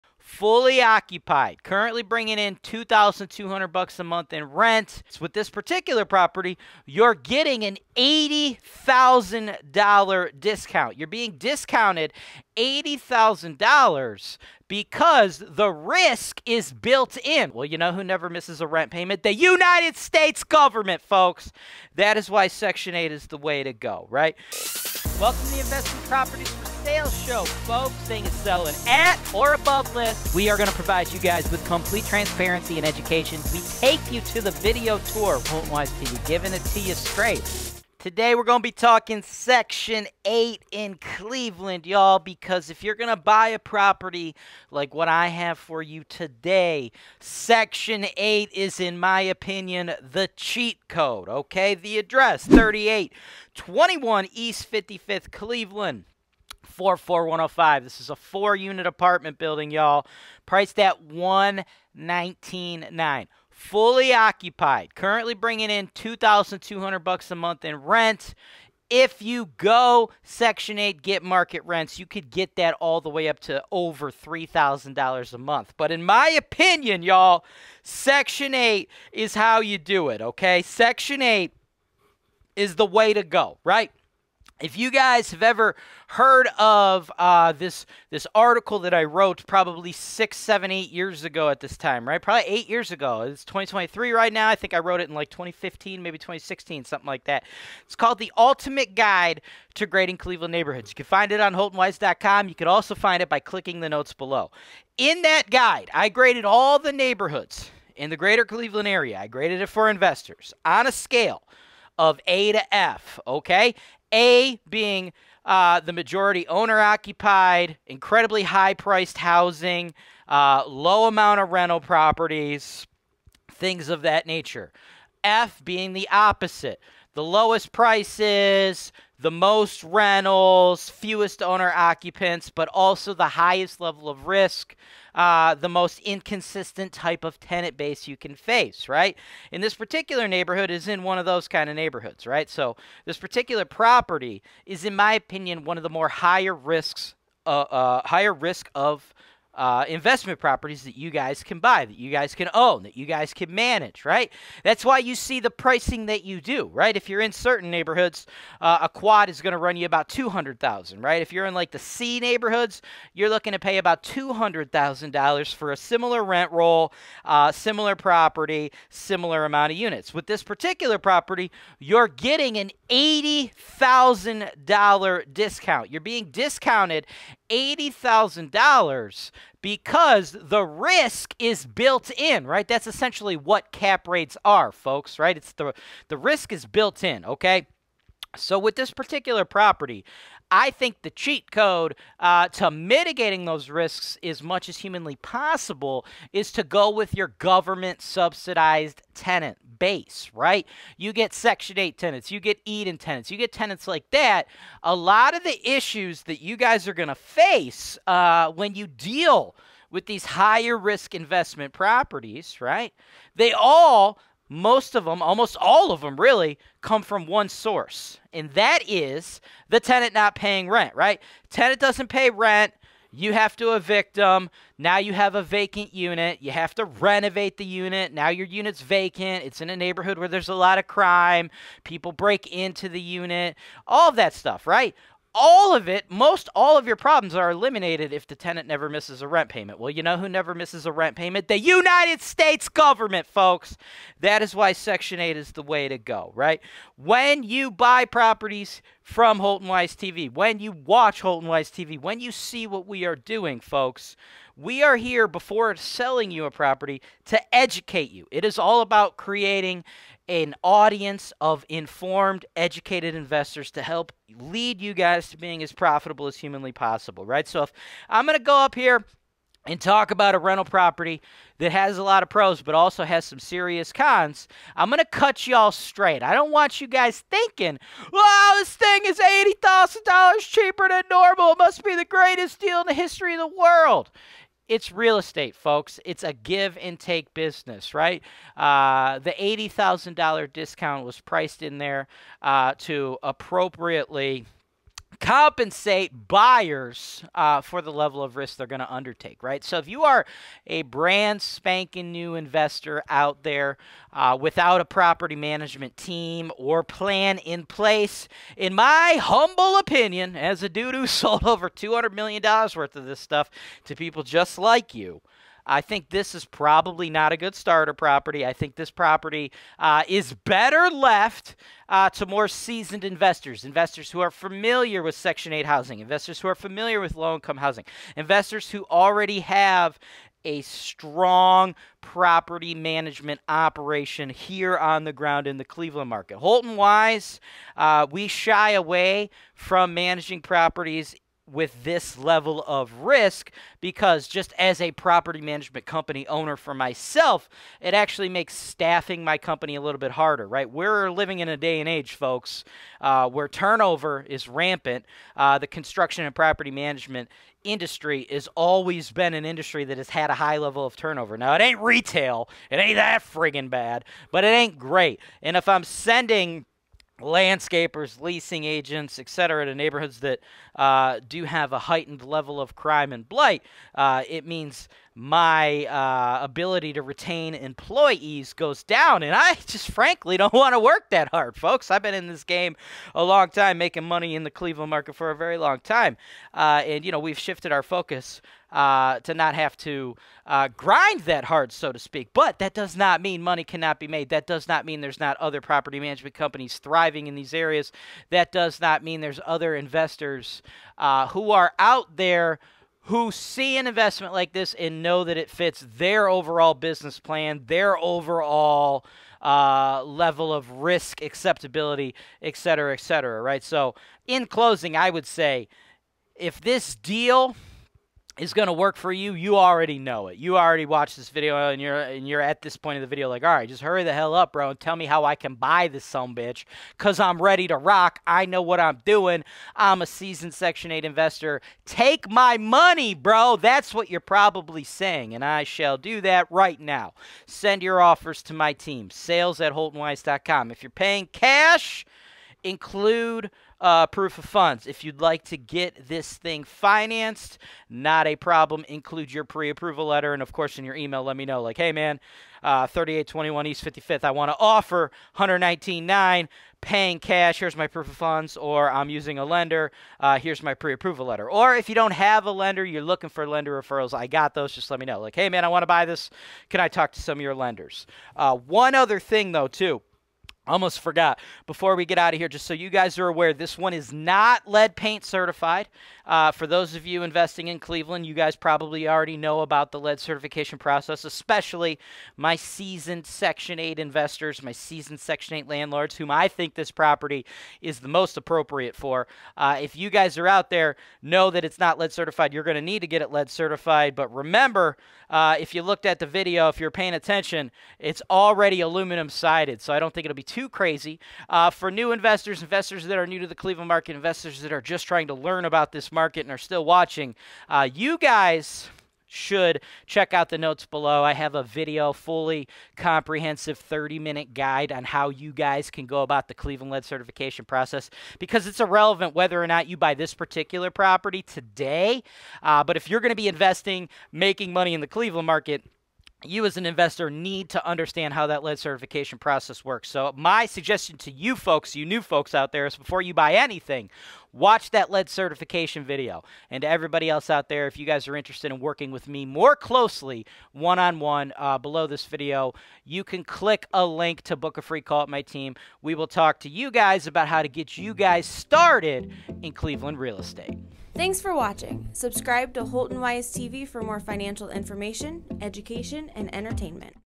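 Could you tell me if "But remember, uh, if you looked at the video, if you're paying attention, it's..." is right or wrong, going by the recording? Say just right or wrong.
right.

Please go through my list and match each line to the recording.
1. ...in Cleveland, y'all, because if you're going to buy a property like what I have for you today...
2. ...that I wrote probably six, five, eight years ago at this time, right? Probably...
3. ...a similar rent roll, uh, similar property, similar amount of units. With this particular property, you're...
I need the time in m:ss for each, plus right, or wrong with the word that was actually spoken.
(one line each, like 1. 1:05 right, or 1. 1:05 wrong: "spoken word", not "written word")
1. 0:40 right
2. 1:28 wrong: "seven", not "five"
3. 2:45 right.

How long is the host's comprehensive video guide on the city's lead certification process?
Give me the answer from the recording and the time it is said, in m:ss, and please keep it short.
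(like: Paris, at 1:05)
30 minutes, at 8:33.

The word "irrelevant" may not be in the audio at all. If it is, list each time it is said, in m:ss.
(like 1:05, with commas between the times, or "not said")
8:38.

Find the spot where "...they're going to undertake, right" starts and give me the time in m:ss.
4:58.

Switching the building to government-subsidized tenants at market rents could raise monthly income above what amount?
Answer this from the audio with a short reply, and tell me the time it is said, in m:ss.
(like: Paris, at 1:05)
$3,000, at 1:14.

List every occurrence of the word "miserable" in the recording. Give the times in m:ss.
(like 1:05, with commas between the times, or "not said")
not said.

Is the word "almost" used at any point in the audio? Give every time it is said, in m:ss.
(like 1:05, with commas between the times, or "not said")
3:35, 7:50.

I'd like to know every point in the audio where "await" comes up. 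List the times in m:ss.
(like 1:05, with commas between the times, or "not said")
not said.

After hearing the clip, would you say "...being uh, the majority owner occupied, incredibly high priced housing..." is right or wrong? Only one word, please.
right.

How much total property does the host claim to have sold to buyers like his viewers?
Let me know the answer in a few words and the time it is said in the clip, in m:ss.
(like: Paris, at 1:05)
$200 million, at 5:11.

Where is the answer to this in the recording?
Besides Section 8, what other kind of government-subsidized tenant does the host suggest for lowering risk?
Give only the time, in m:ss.
3:22.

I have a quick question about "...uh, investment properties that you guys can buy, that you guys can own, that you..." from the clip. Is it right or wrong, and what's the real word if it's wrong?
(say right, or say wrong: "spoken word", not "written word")
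right.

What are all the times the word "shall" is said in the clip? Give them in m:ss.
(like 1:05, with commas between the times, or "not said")
7:15.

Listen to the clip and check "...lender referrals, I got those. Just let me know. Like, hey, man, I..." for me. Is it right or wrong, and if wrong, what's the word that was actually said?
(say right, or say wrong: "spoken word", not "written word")
right.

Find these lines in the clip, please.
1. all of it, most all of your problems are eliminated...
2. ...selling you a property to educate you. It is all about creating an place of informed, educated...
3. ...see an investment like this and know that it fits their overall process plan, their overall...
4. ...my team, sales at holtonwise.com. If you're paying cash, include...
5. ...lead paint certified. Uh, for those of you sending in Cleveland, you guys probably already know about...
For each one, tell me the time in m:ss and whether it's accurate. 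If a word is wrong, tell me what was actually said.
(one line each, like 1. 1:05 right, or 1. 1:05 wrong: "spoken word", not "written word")
1. 3:55 right
2. 4:15 wrong: "audience", not "place"
3. 6:43 wrong: "business", not "process"
4. 7:18 right
5. 7:54 wrong: "investing", not "sending".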